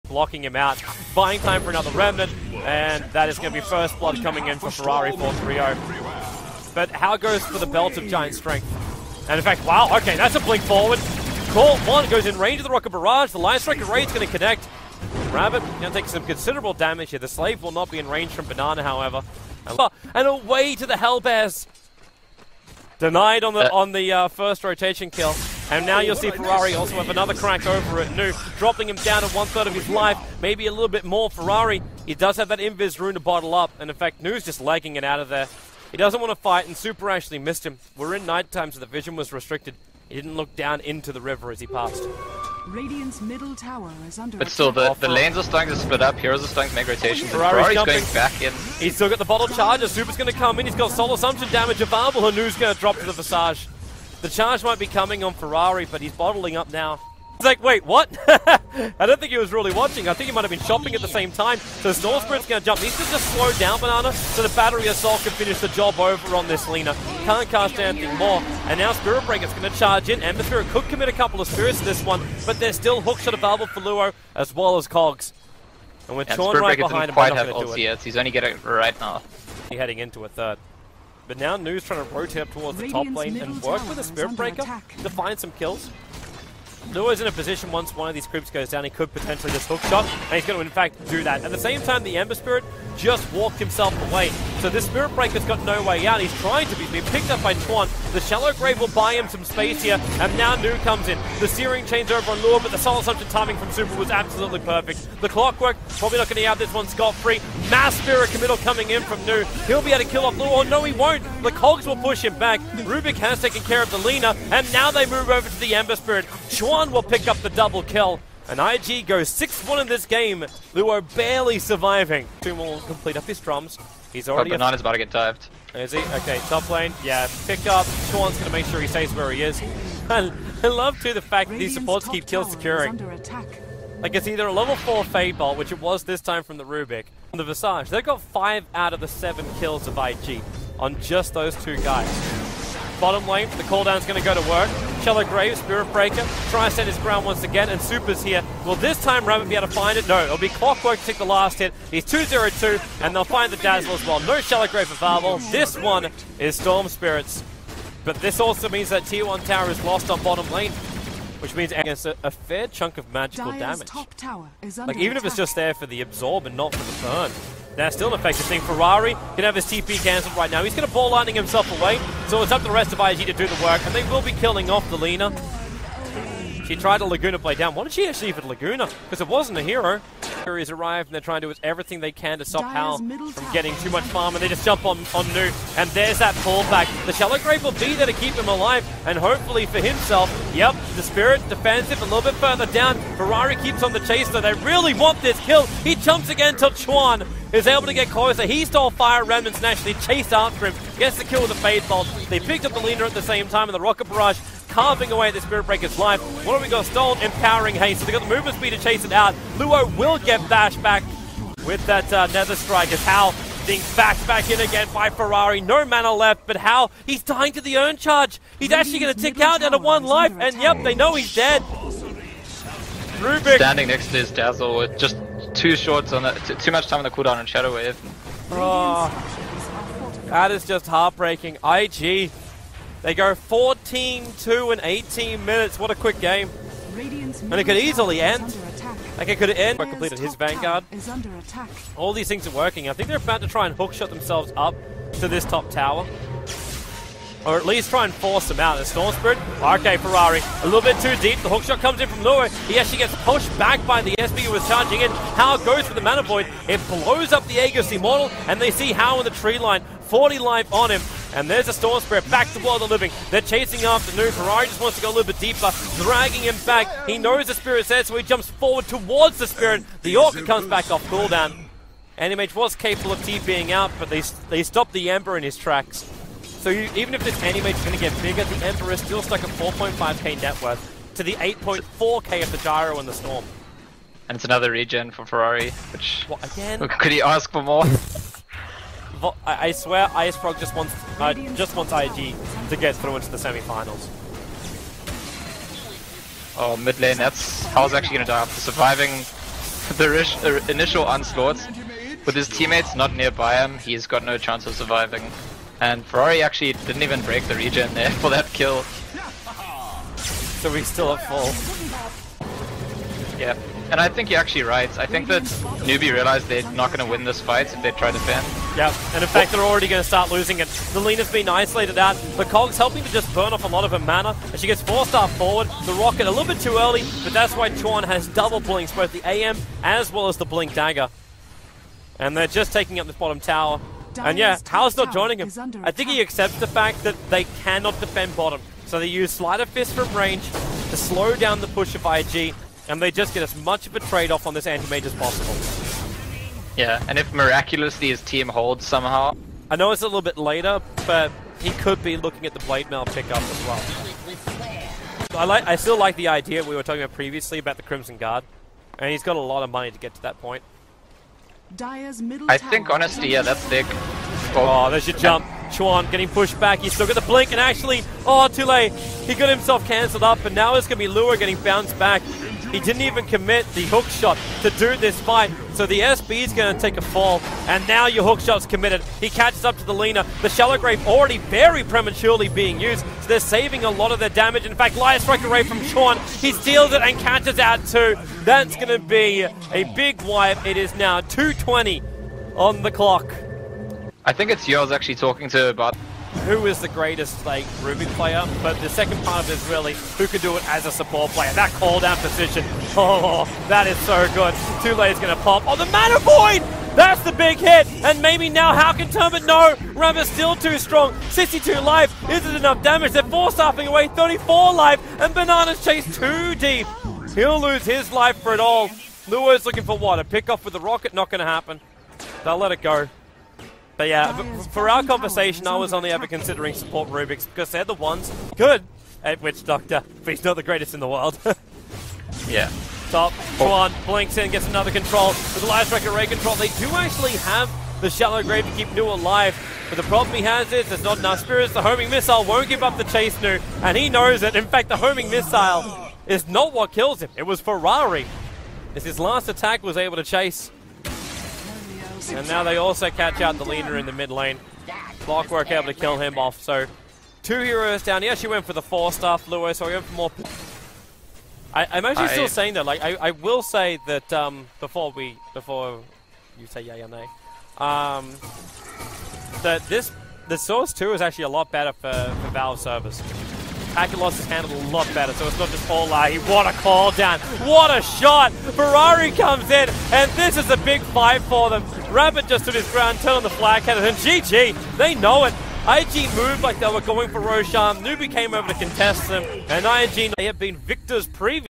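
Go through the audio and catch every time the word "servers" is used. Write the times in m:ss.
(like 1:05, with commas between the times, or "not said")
7:52.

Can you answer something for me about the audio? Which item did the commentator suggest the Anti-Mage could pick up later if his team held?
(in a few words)
Blade Mail.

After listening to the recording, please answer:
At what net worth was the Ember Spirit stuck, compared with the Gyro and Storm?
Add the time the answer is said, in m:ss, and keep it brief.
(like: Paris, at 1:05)
4.5k, at 4:39.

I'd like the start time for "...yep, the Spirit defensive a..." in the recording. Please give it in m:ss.
3:10.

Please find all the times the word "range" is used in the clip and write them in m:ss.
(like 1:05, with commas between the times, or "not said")
0:12, 0:18, 5:40.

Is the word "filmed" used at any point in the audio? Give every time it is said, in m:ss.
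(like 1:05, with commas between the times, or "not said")
not said.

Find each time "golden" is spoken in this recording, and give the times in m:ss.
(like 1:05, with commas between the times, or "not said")
not said.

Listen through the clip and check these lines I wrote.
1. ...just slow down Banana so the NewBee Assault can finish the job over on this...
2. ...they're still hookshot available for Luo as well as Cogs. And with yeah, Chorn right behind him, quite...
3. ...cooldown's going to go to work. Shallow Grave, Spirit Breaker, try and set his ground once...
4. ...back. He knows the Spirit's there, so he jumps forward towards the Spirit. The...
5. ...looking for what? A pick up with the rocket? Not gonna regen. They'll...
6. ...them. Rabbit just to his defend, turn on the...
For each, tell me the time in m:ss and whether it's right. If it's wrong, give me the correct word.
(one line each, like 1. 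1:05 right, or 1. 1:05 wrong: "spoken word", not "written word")
1. 1:03 wrong: "Battery", not "NewBee"
2. 1:12 right
3. 2:23 right
4. 4:26 right
5. 6:59 wrong: "happen", not "regen"
6. 8:01 wrong: "ground", not "defend".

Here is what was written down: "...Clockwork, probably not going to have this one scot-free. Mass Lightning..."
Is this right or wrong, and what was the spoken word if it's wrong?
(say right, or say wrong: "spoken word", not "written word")
wrong: "Spirit", not "Lightning".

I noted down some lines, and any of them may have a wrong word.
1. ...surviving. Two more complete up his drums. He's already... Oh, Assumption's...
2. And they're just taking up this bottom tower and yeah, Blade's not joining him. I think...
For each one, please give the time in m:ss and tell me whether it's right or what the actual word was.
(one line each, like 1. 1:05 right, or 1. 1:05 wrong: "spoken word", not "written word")
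1. 2:01 wrong: "Banana", not "Assumption"
2. 5:32 wrong: "Hal", not "Blade".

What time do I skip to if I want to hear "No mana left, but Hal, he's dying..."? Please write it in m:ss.
3:35.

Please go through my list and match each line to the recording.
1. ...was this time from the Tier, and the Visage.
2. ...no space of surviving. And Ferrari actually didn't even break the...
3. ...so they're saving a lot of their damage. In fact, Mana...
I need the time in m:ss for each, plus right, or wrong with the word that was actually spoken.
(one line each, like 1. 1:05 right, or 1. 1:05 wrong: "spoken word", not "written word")
1. 2:15 wrong: "Rubik", not "Tier"
2. 5:04 wrong: "chance", not "space"
3. 6:23 wrong: "Light", not "Mana".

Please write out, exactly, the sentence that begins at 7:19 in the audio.
But the problem he has is there's not enough spirits.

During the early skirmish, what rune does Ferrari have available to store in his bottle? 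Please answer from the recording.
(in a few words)
Invis rune.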